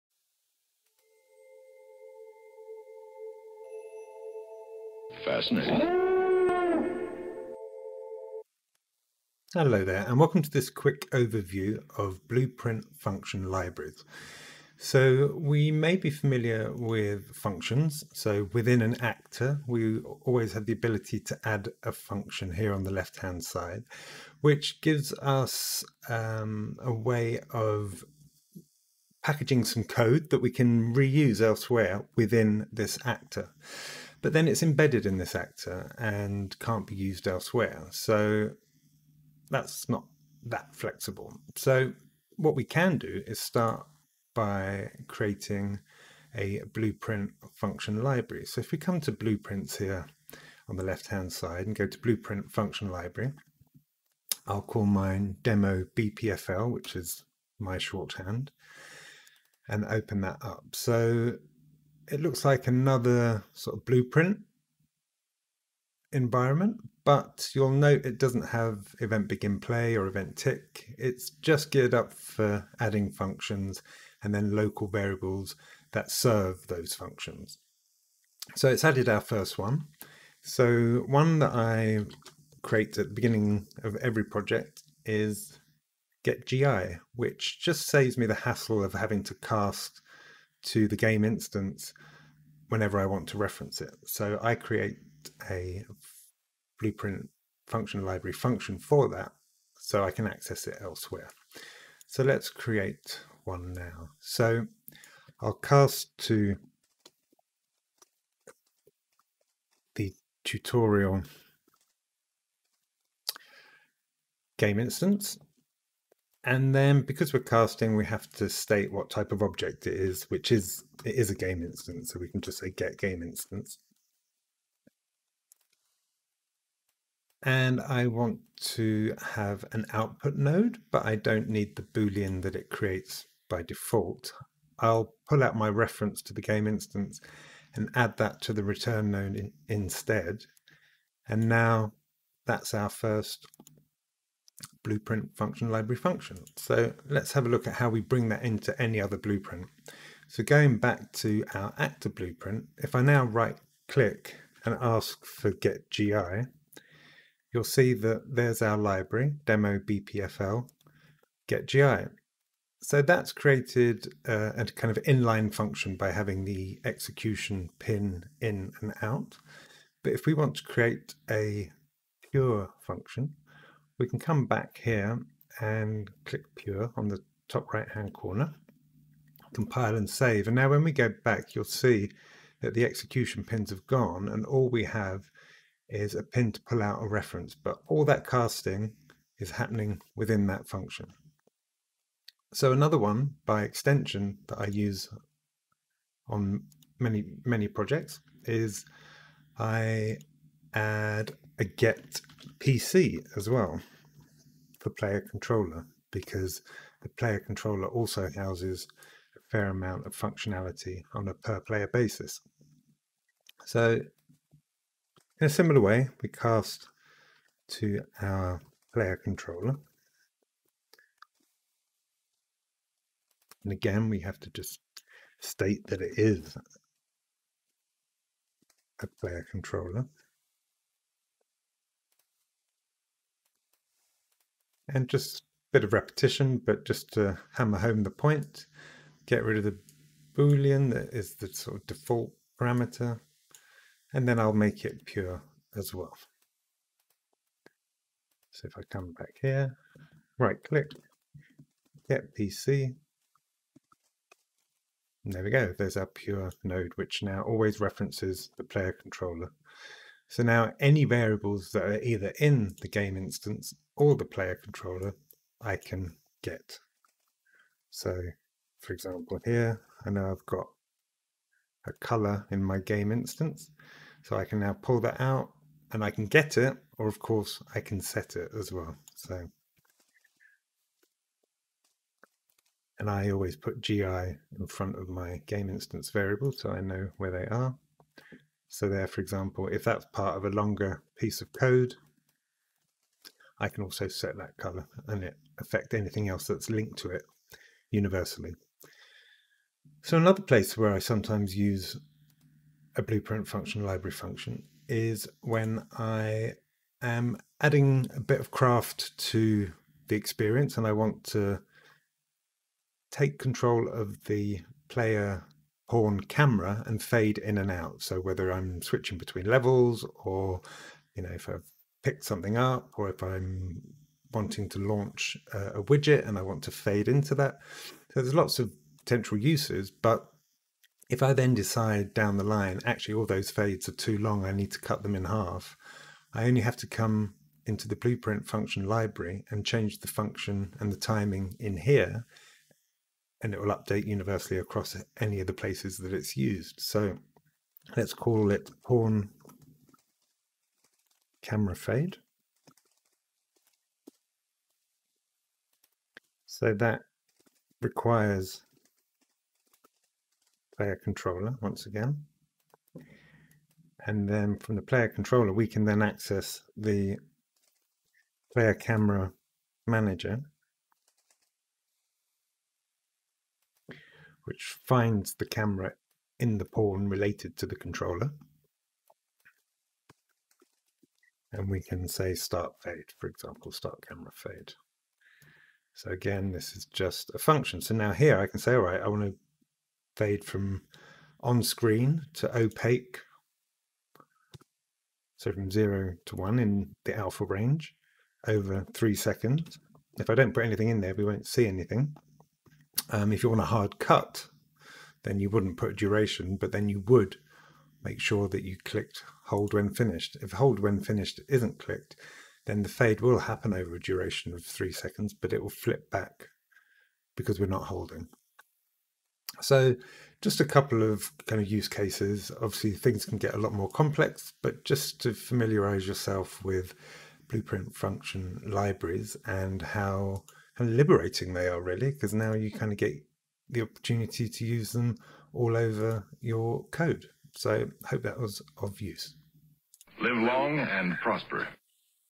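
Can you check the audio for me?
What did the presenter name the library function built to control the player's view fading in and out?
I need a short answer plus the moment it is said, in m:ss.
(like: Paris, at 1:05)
pawn camera fade, at 5:48.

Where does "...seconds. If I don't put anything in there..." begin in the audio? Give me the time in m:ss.
6:39.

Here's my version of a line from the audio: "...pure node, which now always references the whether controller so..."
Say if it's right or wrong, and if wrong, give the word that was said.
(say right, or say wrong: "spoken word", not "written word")
wrong: "player", not "whether".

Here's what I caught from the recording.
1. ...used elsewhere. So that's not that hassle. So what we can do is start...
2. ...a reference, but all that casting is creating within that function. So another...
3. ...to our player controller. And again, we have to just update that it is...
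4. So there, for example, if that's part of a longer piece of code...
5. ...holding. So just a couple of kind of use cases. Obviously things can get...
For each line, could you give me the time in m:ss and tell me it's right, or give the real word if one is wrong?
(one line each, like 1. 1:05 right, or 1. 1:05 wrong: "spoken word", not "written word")
1. 0:36 wrong: "flexible", not "hassle"
2. 3:07 wrong: "happening", not "creating"
3. 3:37 wrong: "state", not "update"
4. 4:48 right
5. 6:57 right.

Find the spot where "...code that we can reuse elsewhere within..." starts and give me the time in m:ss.
0:29.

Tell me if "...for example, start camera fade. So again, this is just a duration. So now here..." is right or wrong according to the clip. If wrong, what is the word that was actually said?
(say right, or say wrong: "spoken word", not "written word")
wrong: "function", not "duration".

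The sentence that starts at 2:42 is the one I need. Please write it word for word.
So that's created uh, a kind of inline function by having the execution pin in and out.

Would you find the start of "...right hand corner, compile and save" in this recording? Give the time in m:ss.
2:57.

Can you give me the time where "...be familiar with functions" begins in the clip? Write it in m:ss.
0:15.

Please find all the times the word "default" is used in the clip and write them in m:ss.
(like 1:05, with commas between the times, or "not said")
2:13, 4:01.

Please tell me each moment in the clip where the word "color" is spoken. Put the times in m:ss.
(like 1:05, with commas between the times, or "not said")
4:31, 4:54.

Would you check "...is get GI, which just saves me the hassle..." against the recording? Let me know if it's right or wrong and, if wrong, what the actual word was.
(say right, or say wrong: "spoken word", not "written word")
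right.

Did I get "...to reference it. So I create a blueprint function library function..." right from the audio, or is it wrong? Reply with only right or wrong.
right.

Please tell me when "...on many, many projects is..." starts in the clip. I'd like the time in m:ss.
3:16.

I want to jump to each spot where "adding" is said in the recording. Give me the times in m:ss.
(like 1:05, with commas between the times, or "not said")
1:12, 5:07.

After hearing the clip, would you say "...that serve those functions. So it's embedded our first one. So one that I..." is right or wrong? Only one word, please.
wrong.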